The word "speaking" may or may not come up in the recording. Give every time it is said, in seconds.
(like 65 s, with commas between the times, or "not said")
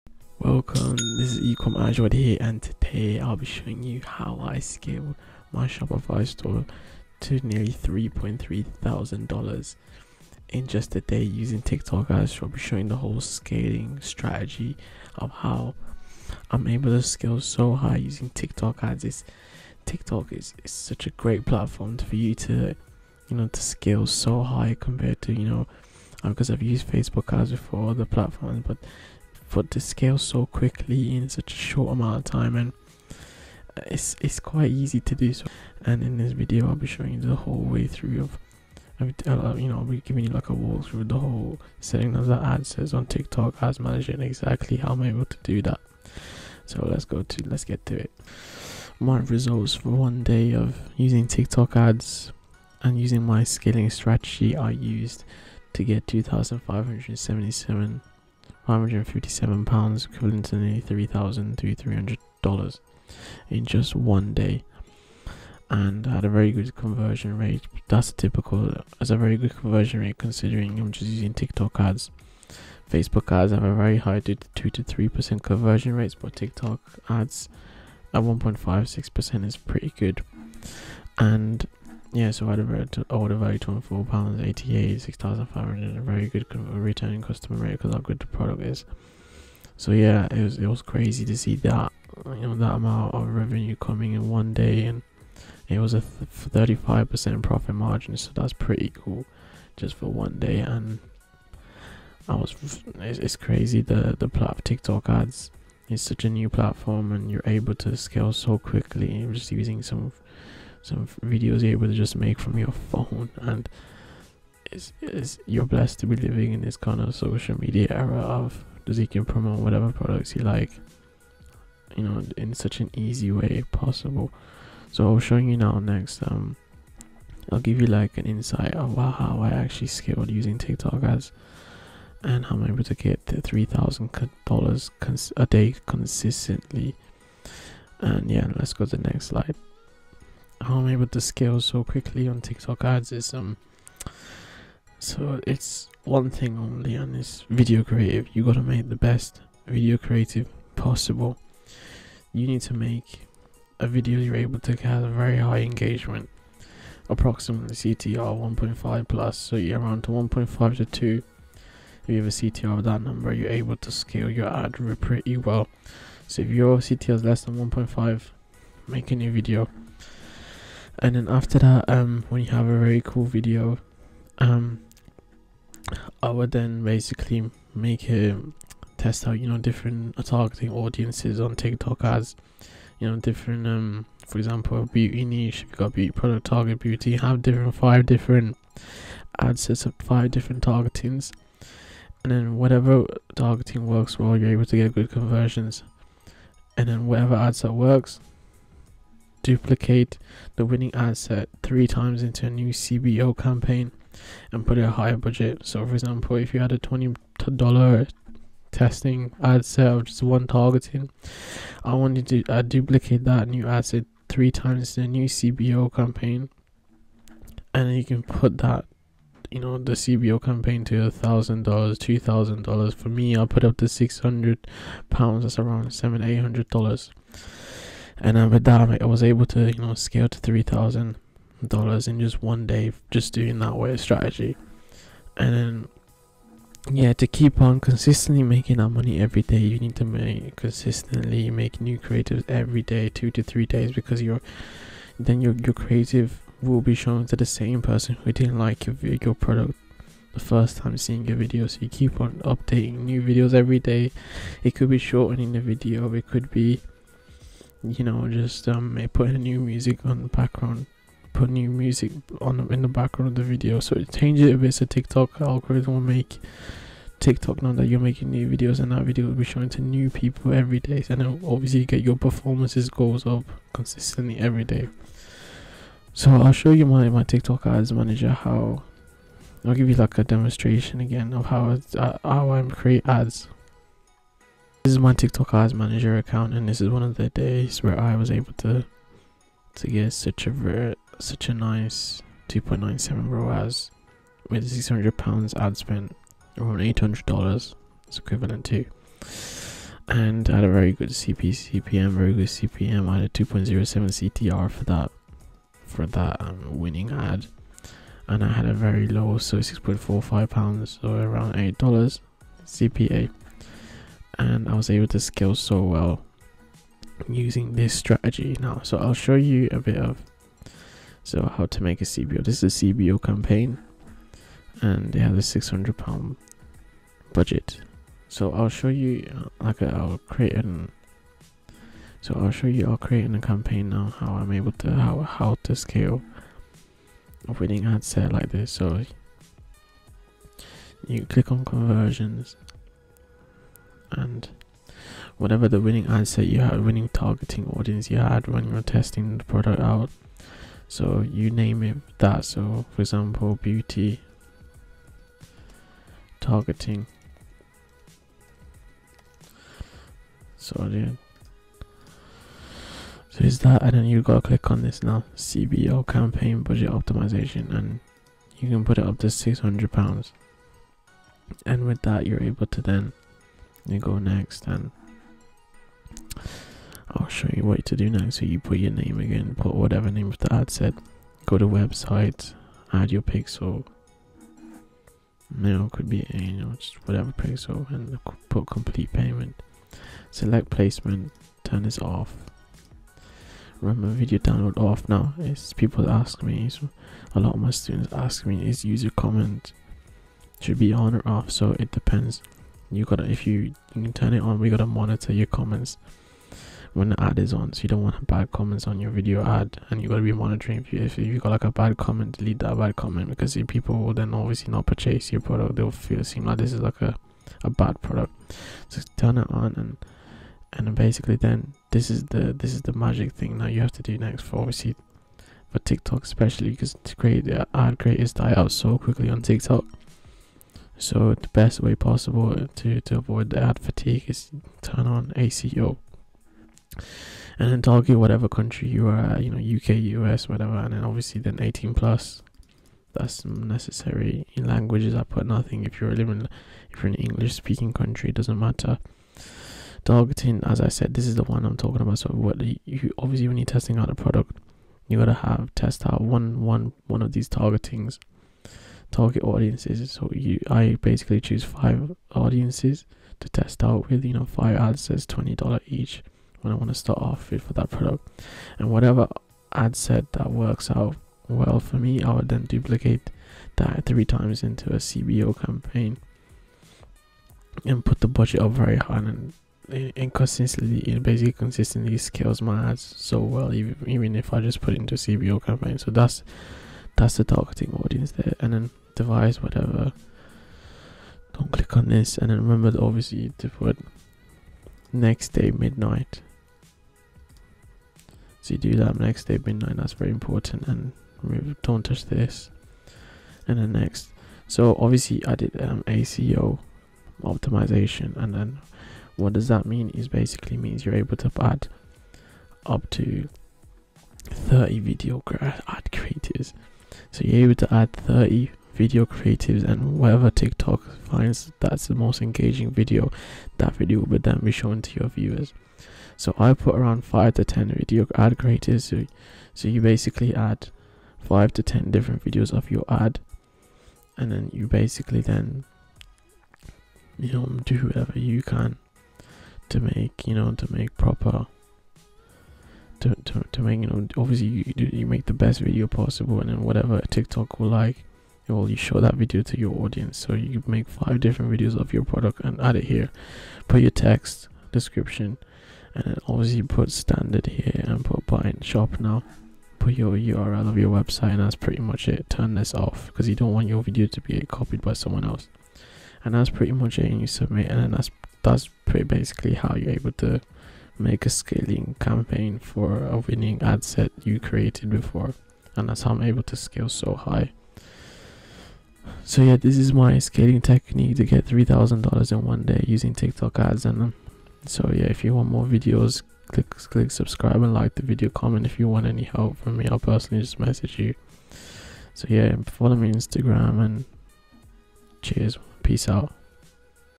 447 s.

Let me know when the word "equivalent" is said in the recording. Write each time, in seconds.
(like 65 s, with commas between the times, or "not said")
60 s, 298 s.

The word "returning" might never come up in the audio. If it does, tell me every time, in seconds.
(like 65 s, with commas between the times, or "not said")
86 s.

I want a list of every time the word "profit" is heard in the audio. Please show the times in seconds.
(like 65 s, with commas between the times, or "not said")
97 s.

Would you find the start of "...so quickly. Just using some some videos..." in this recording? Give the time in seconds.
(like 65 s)
108 s.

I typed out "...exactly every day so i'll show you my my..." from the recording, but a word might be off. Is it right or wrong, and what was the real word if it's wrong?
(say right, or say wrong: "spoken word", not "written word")
wrong: "consistently", not "exactly".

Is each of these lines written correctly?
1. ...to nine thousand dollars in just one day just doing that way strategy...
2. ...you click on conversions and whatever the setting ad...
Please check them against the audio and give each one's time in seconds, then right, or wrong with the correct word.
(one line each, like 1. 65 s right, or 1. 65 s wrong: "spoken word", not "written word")
1. 230 s wrong: "three", not "nine"
2. 341 s wrong: "winning", not "setting".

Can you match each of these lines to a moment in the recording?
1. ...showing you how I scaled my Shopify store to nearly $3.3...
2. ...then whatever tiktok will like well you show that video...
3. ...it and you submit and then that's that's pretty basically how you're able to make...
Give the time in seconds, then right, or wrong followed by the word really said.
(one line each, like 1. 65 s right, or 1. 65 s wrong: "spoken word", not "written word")
1. 3 s right
2. 546 s right
3. 567 s right.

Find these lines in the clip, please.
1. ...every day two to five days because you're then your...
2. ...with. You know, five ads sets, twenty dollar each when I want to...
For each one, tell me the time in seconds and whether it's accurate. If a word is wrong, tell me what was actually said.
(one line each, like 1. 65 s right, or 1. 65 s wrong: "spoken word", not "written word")
1. 242 s wrong: "three", not "five"
2. 464 s right.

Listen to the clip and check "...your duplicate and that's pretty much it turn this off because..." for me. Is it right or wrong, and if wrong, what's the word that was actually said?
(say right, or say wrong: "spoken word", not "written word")
wrong: "website", not "duplicate".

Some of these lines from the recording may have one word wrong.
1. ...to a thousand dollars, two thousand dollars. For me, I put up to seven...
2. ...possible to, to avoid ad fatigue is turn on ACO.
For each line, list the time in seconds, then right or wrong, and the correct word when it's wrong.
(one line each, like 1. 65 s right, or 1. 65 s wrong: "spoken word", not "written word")
1. 220 s wrong: "six", not "seven"
2. 431 s right.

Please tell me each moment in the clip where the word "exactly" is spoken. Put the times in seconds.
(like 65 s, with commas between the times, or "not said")
44 s.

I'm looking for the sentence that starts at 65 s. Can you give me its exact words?
And had a very good conversion rate.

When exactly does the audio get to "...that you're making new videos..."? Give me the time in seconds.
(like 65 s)
267 s.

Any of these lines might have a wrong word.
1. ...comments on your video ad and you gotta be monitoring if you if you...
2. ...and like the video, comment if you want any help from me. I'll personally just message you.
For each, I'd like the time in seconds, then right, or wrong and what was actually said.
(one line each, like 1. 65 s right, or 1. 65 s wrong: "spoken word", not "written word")
1. 408 s right
2. 587 s right.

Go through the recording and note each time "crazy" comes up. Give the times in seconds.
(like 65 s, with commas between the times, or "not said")
90 s, 103 s.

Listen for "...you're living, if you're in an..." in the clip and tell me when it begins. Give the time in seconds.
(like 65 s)
445 s.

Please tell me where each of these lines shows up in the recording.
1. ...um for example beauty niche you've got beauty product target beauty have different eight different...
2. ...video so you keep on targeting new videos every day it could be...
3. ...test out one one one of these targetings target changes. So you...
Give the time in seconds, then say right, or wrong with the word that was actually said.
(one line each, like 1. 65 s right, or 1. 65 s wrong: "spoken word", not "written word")
1. 183 s wrong: "five", not "eight"
2. 251 s wrong: "updating", not "targeting"
3. 455 s wrong: "audiences", not "changes".